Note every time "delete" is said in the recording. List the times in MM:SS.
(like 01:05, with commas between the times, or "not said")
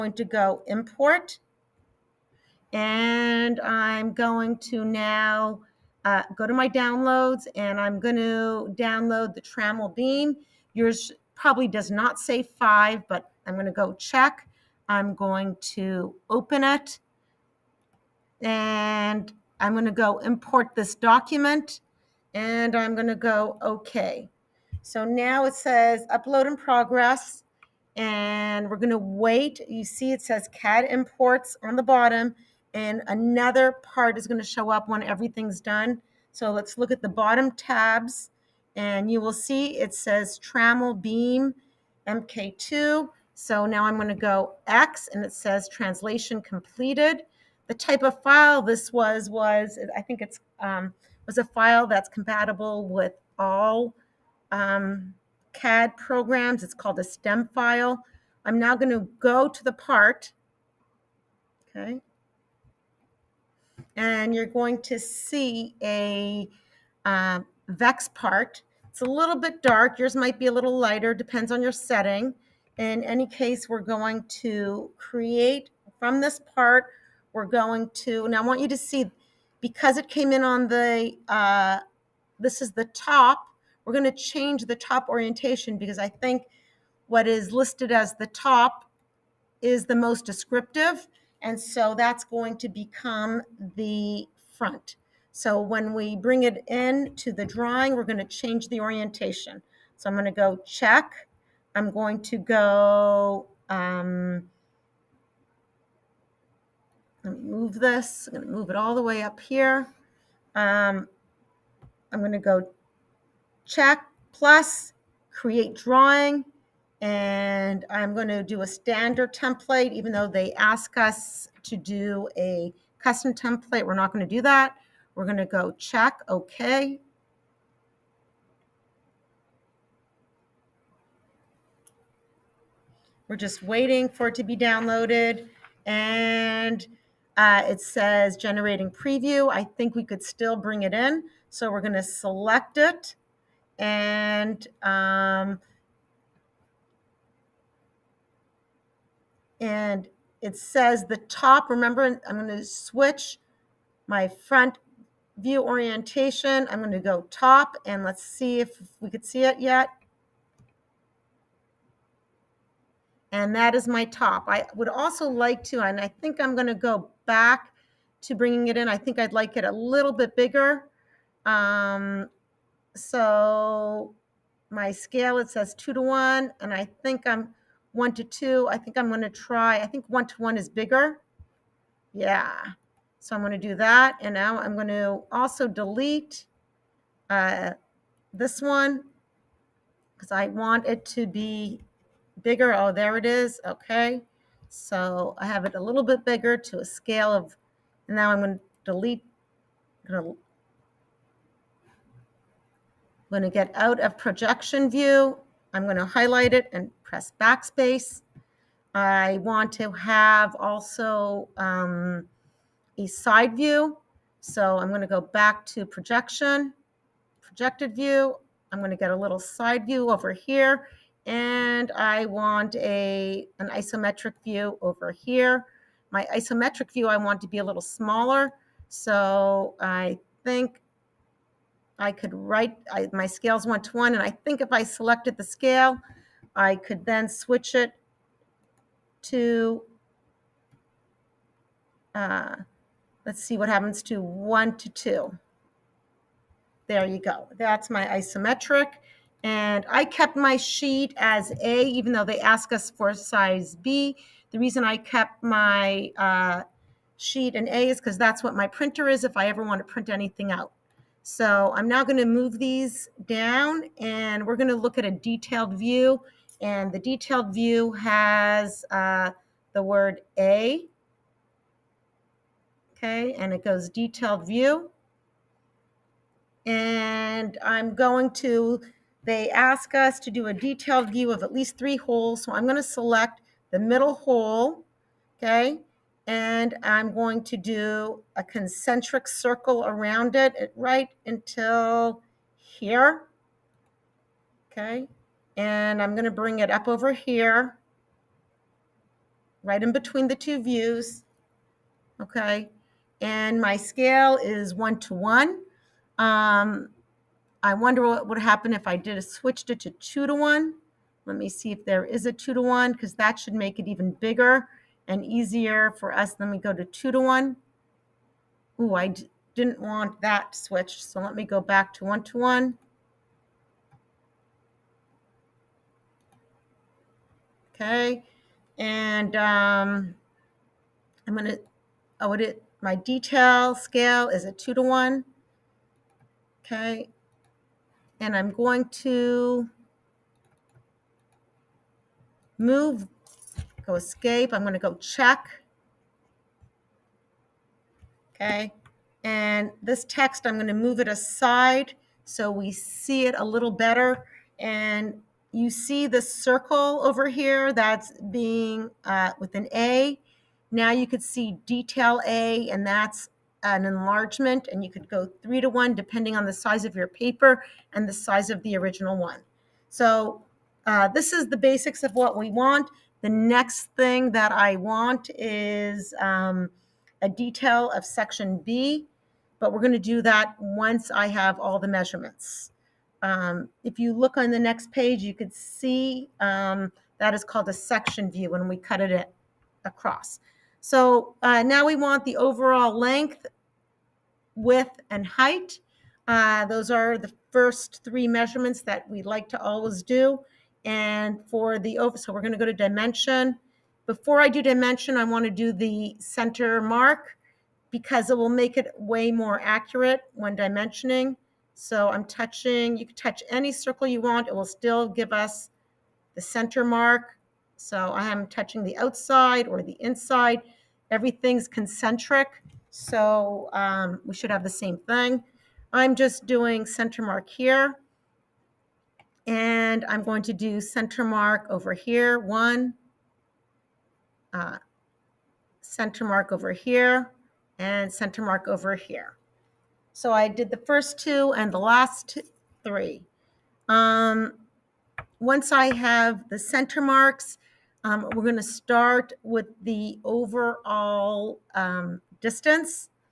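03:05, 03:18.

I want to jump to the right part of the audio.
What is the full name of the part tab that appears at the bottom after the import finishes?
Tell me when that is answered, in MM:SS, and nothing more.
00:40.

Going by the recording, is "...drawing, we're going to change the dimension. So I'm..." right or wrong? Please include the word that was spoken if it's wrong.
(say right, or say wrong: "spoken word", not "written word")
wrong: "orientation", not "dimension".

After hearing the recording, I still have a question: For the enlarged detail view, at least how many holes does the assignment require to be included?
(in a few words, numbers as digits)
3.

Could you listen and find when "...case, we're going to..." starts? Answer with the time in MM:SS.
01:13.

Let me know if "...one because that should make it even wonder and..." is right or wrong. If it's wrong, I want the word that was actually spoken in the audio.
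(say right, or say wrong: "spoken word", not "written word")
wrong: "bigger", not "wonder".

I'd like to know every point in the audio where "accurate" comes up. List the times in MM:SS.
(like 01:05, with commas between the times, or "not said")
06:49.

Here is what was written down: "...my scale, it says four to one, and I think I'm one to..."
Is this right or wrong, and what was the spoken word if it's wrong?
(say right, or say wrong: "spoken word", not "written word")
wrong: "two", not "four".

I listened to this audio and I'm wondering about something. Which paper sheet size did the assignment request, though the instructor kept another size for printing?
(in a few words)
Size B.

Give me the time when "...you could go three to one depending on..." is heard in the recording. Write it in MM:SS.
06:04.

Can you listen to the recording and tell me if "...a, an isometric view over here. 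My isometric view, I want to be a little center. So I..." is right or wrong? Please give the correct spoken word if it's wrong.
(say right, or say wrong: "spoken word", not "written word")
wrong: "smaller", not "center".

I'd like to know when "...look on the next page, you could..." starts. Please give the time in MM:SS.
06:24.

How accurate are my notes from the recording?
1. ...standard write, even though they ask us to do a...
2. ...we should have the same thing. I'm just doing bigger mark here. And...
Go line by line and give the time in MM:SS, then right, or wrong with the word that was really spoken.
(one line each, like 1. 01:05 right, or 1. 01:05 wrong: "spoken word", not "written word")
1. 01:58 wrong: "template", not "write"
2. 07:04 wrong: "center", not "bigger".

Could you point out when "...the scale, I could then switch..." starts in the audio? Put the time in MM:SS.
03:55.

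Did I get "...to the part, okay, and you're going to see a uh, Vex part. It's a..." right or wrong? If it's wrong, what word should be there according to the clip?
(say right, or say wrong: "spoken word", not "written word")
right.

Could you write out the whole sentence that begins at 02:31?
Remember, I'm going to switch my front view orientation.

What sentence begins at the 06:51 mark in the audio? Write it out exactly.
So I'm touching, you can touch any circle you want.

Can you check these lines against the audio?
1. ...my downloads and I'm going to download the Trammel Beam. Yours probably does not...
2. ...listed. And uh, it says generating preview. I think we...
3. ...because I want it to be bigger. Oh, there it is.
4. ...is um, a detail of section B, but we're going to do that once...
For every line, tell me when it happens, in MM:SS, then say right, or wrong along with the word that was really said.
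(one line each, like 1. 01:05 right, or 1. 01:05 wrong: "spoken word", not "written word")
1. 00:06 right
2. 02:14 wrong: "downloaded", not "listed"
3. 03:10 right
4. 06:15 right.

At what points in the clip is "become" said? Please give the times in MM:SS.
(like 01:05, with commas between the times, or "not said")
01:32.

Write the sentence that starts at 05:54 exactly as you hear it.
And you see the circle over here that's being uh, with an A.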